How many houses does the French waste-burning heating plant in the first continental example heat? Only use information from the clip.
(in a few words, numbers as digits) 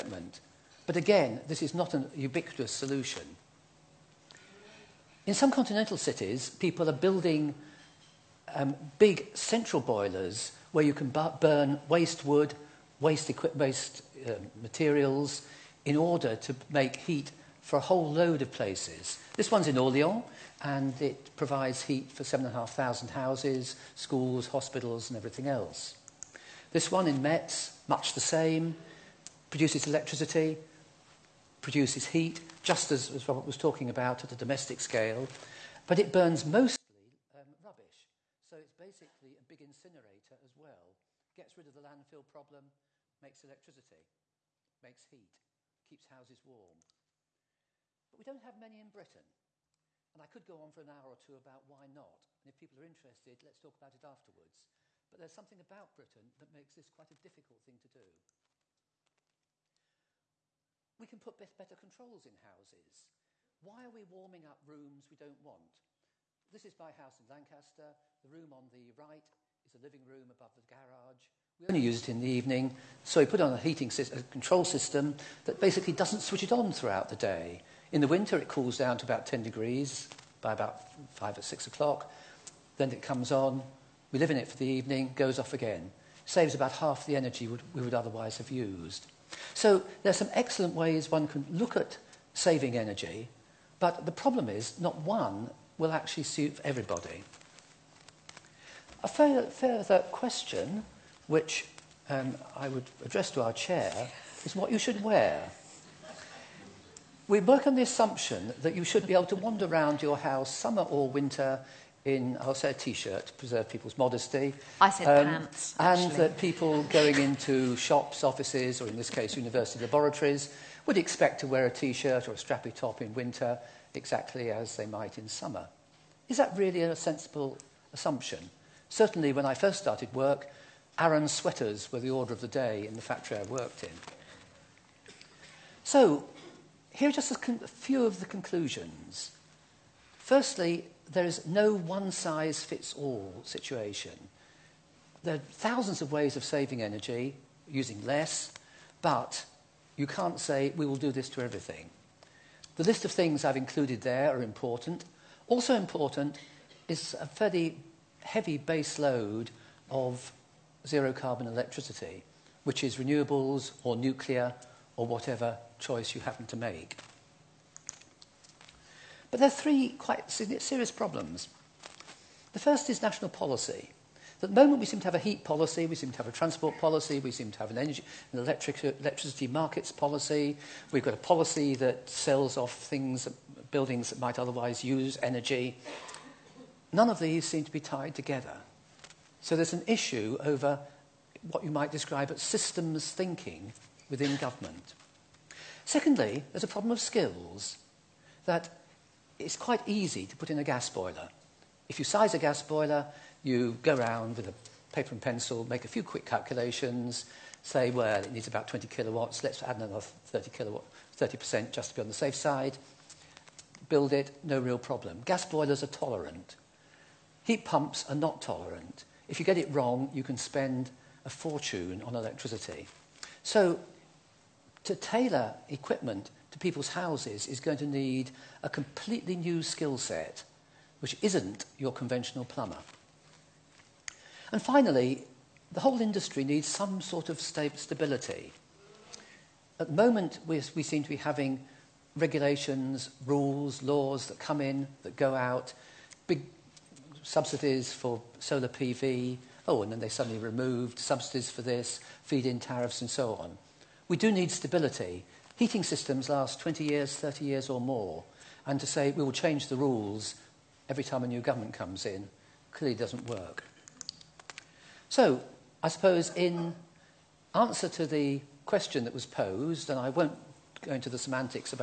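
7,500.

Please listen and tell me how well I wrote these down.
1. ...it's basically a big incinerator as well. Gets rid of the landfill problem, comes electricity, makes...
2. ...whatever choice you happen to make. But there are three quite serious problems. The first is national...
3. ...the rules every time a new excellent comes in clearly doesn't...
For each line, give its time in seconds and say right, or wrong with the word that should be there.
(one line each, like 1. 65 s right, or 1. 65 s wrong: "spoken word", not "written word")
1. 38 s wrong: "makes", not "comes"
2. 165 s right
3. 259 s wrong: "government", not "excellent".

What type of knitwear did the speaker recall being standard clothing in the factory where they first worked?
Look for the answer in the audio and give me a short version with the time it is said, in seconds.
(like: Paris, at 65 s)
Aran sweaters, at 130 s.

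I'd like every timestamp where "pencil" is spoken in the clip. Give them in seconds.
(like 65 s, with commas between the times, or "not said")
205 s.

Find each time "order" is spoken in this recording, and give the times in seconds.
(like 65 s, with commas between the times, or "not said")
15 s, 132 s.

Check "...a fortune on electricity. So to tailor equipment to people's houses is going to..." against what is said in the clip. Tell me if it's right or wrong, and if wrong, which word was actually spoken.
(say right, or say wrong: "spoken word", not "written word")
right.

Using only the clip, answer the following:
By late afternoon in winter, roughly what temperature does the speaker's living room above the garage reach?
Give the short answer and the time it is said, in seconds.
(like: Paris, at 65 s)
10 degrees, at 79 s.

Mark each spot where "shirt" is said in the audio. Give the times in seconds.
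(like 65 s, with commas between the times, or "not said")
112 s, 121 s.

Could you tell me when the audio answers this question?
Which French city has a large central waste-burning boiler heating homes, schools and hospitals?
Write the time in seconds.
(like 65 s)
19 s.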